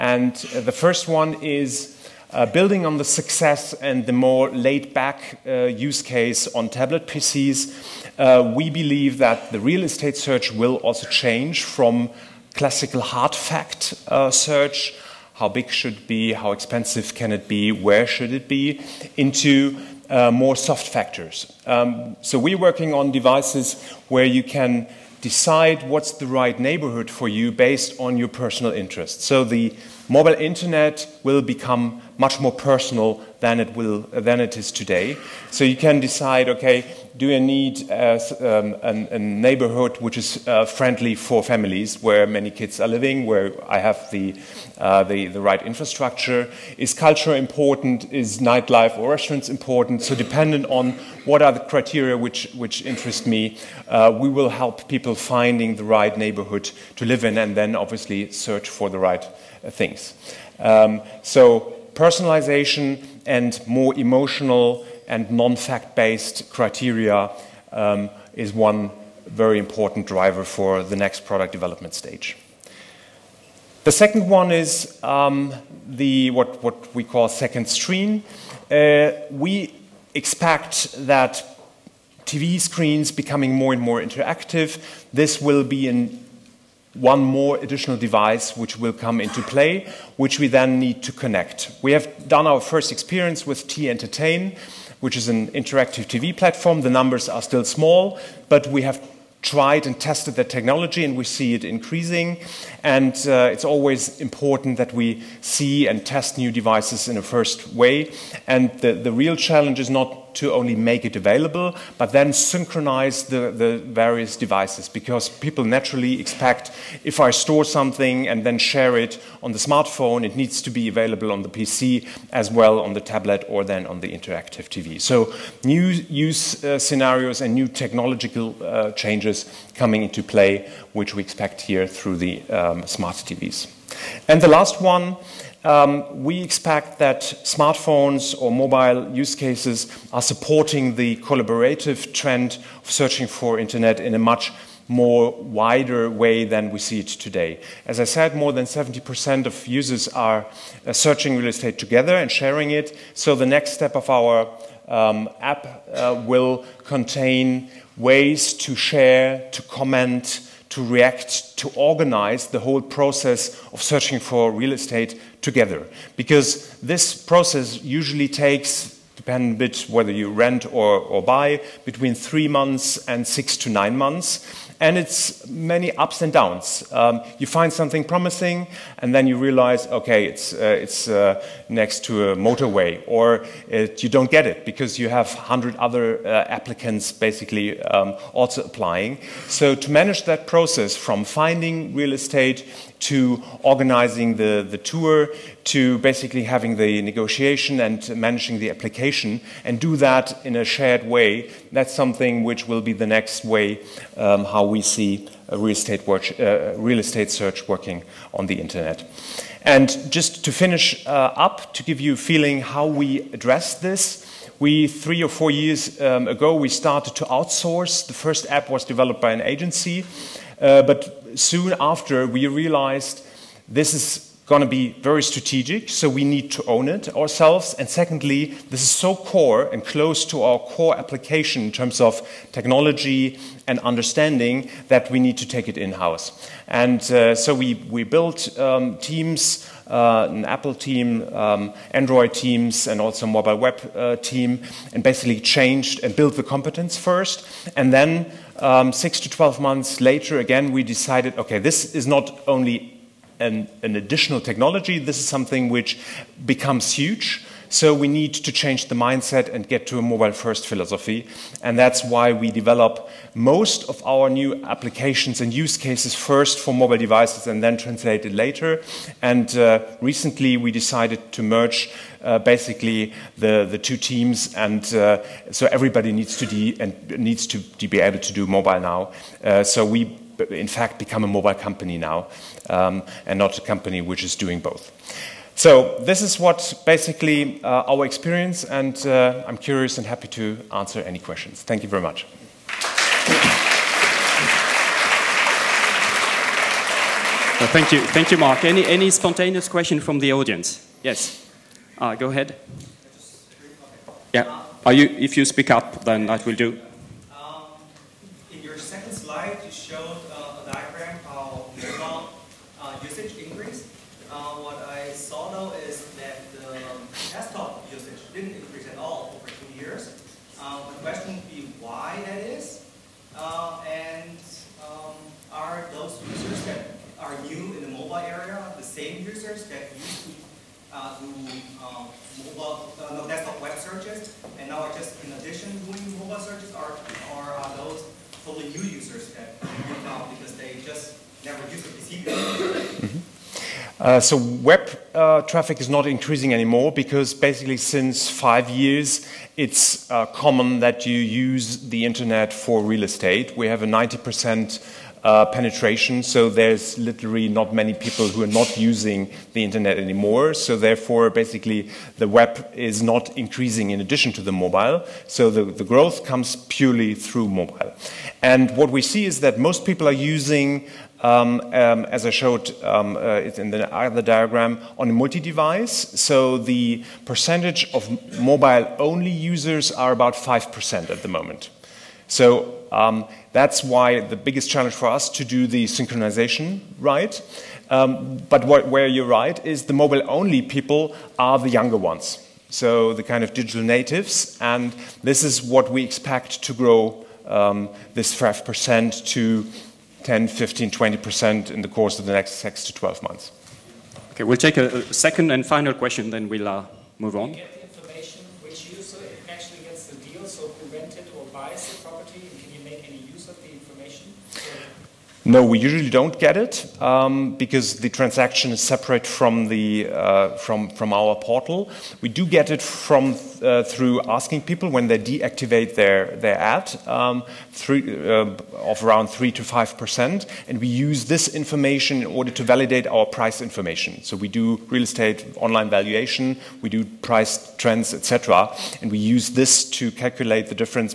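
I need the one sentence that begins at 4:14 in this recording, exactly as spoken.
This is something which becomes huge.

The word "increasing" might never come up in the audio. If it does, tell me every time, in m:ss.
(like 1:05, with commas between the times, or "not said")
1:41, 5:46, 6:03.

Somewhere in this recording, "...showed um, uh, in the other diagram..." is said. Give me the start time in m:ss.
6:12.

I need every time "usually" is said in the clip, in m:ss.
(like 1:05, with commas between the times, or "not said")
2:47, 6:55.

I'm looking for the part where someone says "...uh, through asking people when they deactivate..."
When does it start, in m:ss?
7:03.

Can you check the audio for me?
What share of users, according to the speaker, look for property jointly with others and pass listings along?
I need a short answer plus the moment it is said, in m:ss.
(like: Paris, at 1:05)
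more than 70%, at 2:28.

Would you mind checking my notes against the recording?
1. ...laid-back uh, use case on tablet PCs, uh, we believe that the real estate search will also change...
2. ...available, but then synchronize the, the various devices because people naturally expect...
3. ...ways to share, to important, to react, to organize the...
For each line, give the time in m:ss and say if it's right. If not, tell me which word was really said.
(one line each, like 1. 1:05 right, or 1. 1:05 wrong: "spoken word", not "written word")
1. 0:04 right
2. 1:51 right
3. 2:37 wrong: "comment", not "important".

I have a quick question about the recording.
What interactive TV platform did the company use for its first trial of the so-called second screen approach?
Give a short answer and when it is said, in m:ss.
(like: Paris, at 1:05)
T-Entertain, at 1:33.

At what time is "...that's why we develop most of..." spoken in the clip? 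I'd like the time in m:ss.
4:21.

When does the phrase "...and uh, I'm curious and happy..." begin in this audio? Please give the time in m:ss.
4:48.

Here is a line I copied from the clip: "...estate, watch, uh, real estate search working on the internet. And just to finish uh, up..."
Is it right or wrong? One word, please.
right.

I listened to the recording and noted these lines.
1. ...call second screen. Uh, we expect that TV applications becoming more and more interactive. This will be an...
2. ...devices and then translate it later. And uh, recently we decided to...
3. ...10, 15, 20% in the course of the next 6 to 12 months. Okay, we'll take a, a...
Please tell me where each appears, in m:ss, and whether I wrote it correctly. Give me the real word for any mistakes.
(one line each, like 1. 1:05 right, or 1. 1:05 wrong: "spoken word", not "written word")
1. 1:17 wrong: "screens", not "applications"
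2. 4:26 right
3. 6:40 right.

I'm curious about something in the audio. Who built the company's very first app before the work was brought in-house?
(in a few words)
an agency.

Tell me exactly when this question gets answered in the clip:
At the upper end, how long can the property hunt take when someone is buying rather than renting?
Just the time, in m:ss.
2:53.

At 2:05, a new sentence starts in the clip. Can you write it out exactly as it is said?
So new use uh, scenarios and new technological uh, changes coming into play, which we expect here through the um, smart TVs.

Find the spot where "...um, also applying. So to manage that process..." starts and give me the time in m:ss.
3:07.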